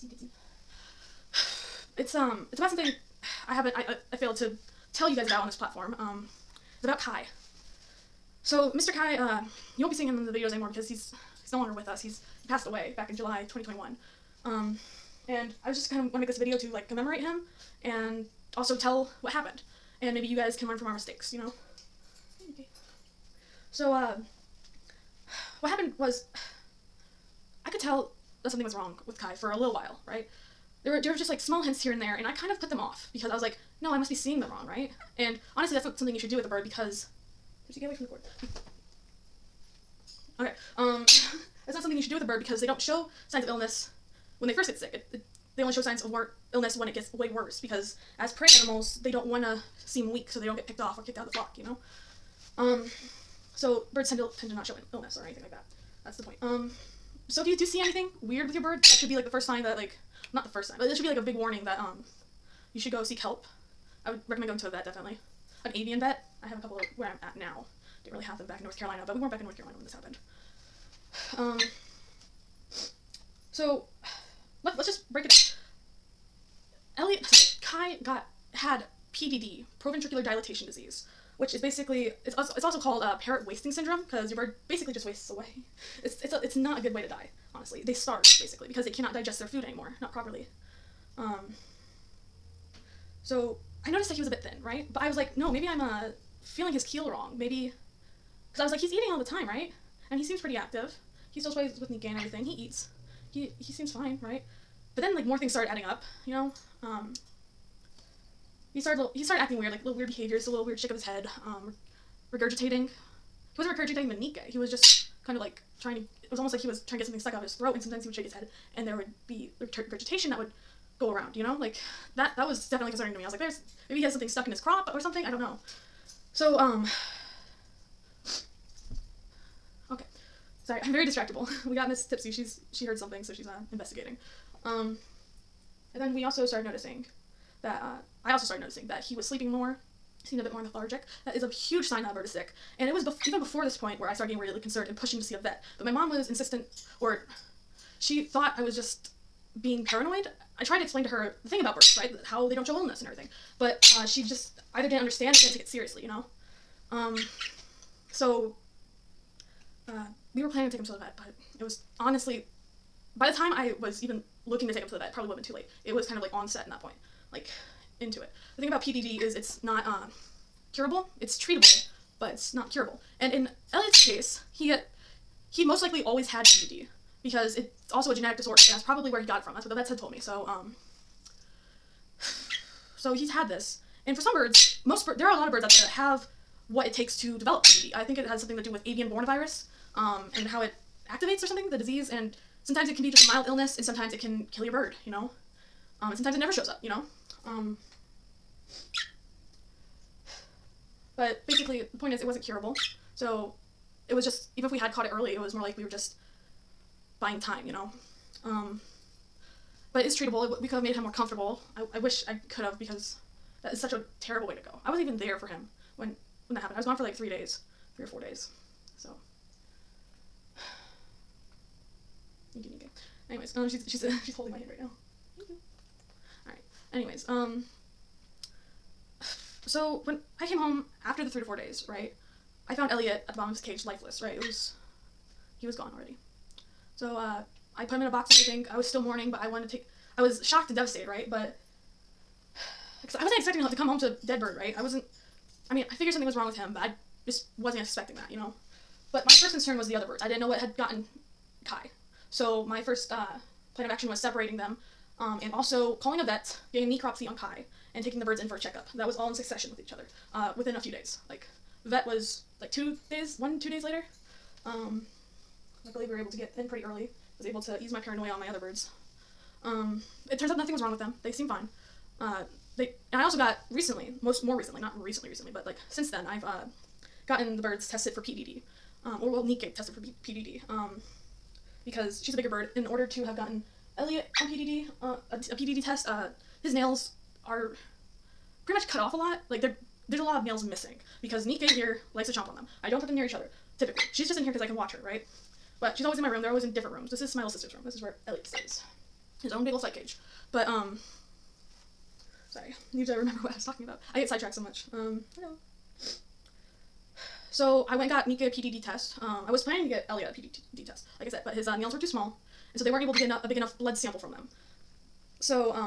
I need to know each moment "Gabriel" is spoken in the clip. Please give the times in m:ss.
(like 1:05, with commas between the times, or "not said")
not said.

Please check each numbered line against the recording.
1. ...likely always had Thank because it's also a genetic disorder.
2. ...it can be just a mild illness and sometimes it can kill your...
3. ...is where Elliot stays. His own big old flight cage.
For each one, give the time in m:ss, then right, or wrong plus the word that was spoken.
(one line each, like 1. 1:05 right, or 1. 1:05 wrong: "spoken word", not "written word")
1. 2:55 wrong: "PDD", not "Thank"
2. 3:12 right
3. 4:57 right.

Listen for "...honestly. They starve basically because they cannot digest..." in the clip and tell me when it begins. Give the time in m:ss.
1:27.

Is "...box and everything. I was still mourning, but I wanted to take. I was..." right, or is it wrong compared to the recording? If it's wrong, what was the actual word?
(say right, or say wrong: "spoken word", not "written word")
right.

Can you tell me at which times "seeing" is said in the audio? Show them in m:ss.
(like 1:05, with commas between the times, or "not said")
0:09, 0:34.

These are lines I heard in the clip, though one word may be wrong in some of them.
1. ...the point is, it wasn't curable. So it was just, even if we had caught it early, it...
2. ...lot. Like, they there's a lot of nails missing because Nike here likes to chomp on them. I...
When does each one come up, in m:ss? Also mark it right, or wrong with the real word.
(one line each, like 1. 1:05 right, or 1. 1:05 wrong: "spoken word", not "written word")
1. 3:21 right
2. 4:49 right.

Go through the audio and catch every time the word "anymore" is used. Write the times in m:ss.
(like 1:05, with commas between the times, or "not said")
0:10, 1:29.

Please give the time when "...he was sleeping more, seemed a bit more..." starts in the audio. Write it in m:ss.
2:19.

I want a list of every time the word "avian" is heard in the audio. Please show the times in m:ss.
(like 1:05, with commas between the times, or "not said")
1:05, 3:08.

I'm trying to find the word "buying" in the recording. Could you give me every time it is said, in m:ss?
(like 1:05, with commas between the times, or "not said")
3:27.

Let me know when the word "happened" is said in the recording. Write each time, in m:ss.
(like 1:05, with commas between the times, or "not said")
0:19, 0:25, 1:09, 3:36.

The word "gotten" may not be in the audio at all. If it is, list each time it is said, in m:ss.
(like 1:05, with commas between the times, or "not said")
4:10, 4:37, 4:43.